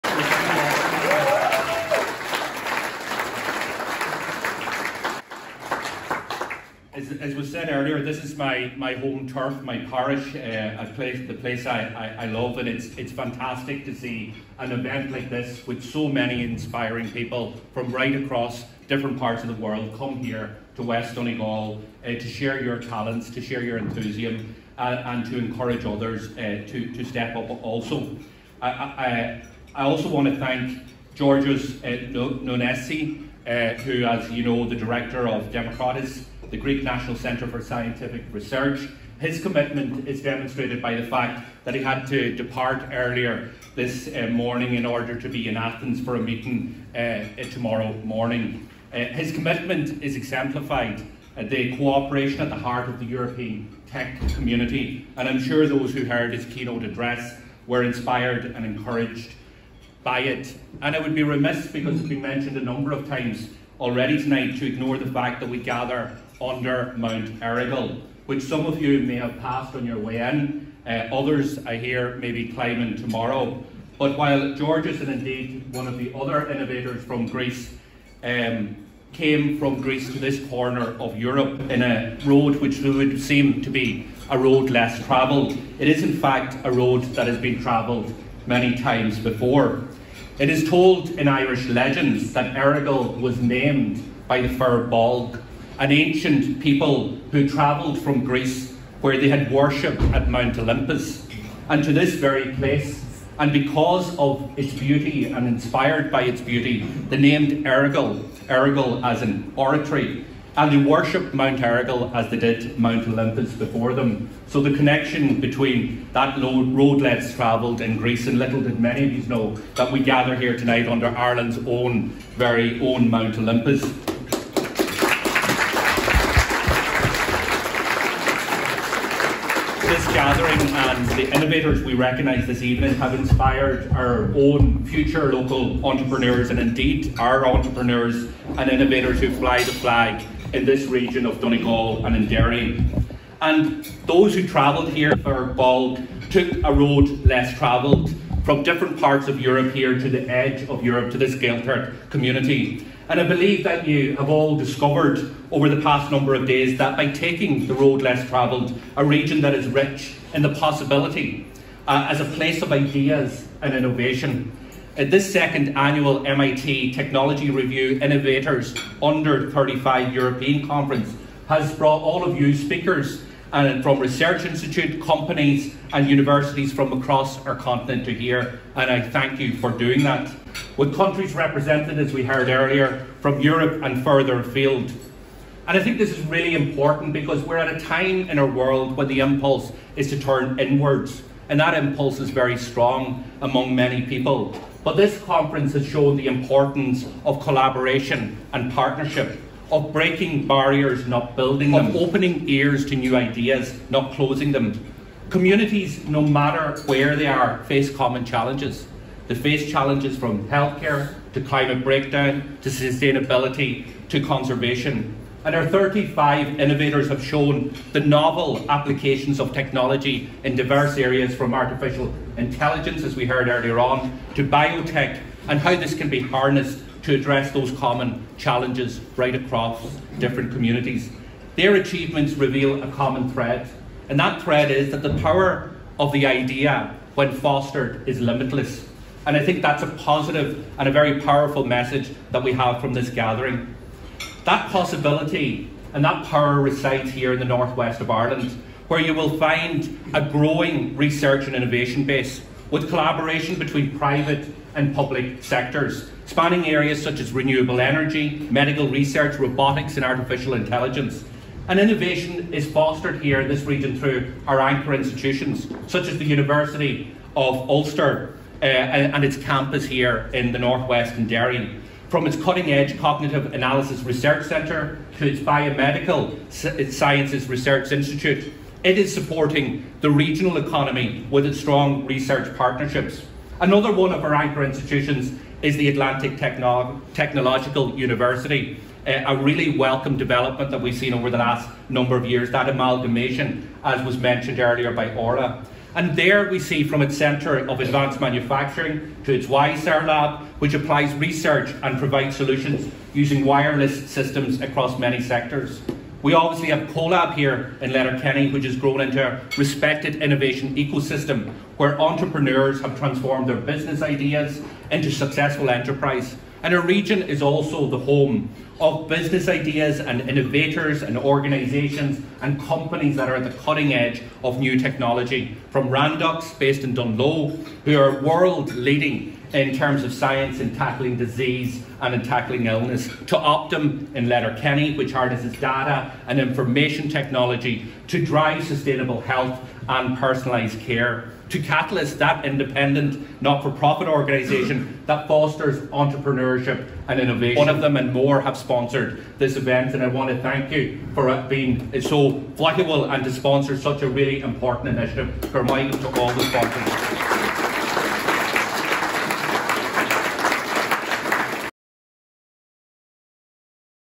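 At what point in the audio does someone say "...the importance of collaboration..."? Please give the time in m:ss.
3:16.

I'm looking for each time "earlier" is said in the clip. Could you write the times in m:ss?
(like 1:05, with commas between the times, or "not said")
0:07, 0:42, 3:02, 3:43, 4:54.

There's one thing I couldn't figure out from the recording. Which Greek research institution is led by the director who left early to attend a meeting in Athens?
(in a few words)
Demokritos.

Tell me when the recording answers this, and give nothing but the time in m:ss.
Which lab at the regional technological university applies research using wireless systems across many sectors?
4:59.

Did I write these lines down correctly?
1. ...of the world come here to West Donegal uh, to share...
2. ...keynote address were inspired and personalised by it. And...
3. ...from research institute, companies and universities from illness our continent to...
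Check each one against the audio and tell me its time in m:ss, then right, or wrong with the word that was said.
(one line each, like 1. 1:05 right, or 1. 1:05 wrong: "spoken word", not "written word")
1. 0:19 right
2. 0:56 wrong: "encouraged", not "personalised"
3. 2:53 wrong: "across", not "illness".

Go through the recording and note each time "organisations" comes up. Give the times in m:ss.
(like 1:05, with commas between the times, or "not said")
5:21, 5:44.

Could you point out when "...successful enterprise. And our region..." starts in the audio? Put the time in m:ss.
5:15.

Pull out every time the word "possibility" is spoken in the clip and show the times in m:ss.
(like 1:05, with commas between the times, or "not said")
2:40, 4:04.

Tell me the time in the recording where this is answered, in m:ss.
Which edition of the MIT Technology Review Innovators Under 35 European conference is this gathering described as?
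2:45.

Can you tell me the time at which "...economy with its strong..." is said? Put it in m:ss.
4:40.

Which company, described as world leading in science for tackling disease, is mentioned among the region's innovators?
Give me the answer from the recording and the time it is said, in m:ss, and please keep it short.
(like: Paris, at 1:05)
Randox, at 5:25.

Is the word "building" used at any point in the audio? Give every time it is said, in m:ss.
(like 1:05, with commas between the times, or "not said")
3:21.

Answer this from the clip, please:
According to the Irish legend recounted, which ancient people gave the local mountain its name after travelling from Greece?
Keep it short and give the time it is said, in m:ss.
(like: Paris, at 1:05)
Fir Bolg, at 1:34.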